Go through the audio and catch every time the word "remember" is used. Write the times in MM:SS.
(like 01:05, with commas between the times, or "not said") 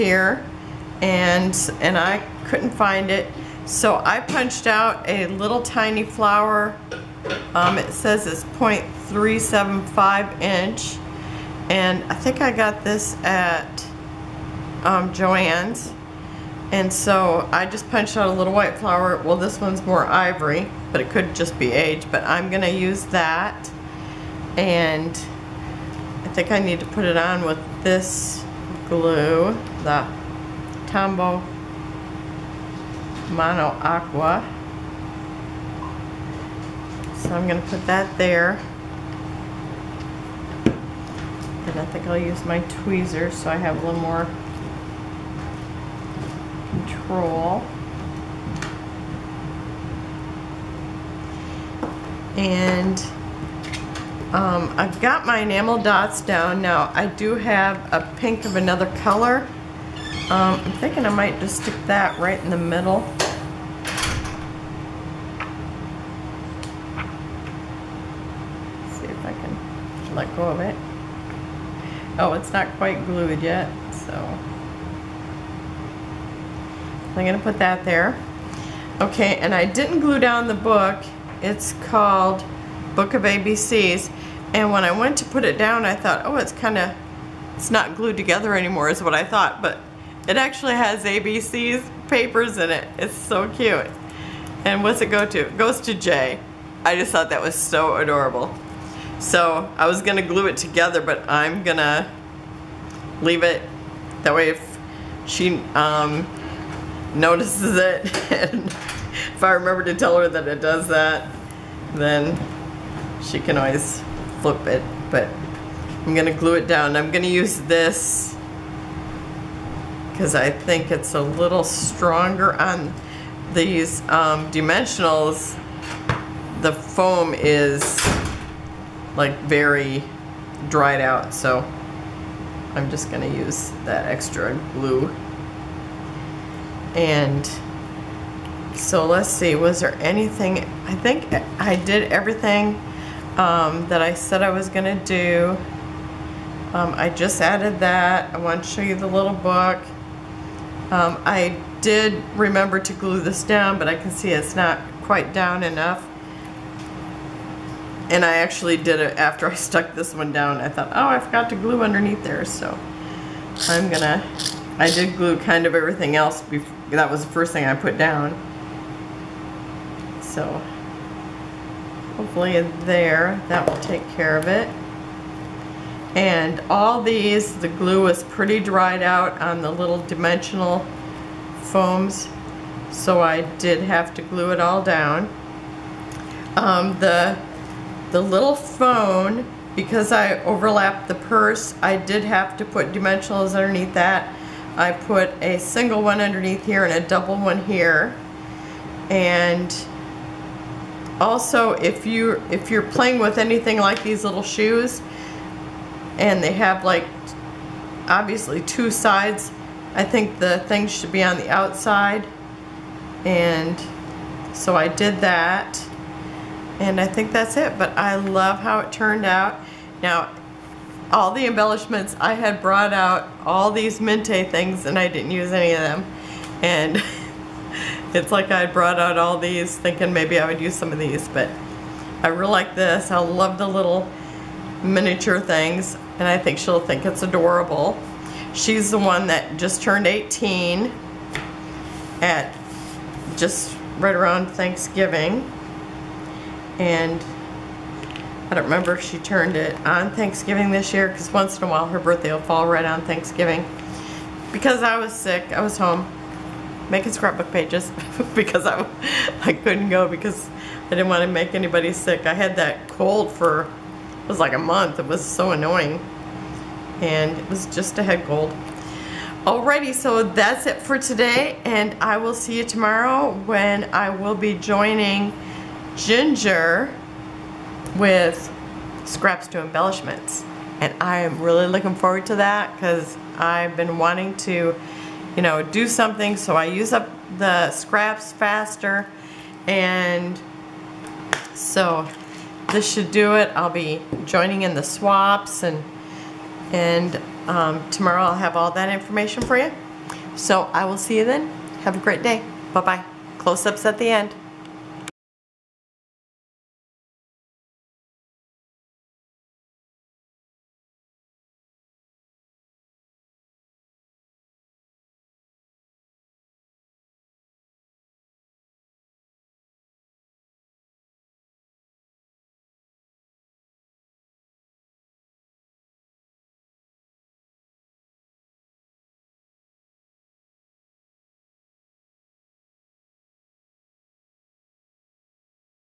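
01:49, 02:32, 04:08.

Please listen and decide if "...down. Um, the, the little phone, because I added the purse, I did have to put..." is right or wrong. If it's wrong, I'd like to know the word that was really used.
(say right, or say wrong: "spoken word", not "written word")
wrong: "overlapped", not "added".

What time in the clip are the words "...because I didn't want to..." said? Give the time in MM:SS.
04:20.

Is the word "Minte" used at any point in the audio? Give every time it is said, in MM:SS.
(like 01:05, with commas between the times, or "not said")
03:43.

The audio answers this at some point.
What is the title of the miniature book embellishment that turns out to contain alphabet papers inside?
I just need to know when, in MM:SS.
01:22.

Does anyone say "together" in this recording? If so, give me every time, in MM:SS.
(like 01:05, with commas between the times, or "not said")
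01:28, 01:40.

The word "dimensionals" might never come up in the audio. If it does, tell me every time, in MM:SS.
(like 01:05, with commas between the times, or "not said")
02:04, 03:00, 03:12.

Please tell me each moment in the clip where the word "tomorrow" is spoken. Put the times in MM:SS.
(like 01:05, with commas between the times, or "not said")
04:32, 04:57.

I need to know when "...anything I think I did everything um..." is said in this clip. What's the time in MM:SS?
02:19.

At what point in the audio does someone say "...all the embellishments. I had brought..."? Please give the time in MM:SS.
03:41.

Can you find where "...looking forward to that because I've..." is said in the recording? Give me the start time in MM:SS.
04:41.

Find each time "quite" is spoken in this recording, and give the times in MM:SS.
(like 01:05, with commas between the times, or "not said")
01:12, 02:35.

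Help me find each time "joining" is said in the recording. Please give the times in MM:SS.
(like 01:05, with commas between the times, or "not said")
04:34, 04:54.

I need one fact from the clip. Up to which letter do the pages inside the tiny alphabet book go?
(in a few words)
J.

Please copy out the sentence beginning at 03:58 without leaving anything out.
She's the one that just turned 18 at just right around Thanksgiving.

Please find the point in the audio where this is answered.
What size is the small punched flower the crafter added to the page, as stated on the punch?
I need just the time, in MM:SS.
00:08.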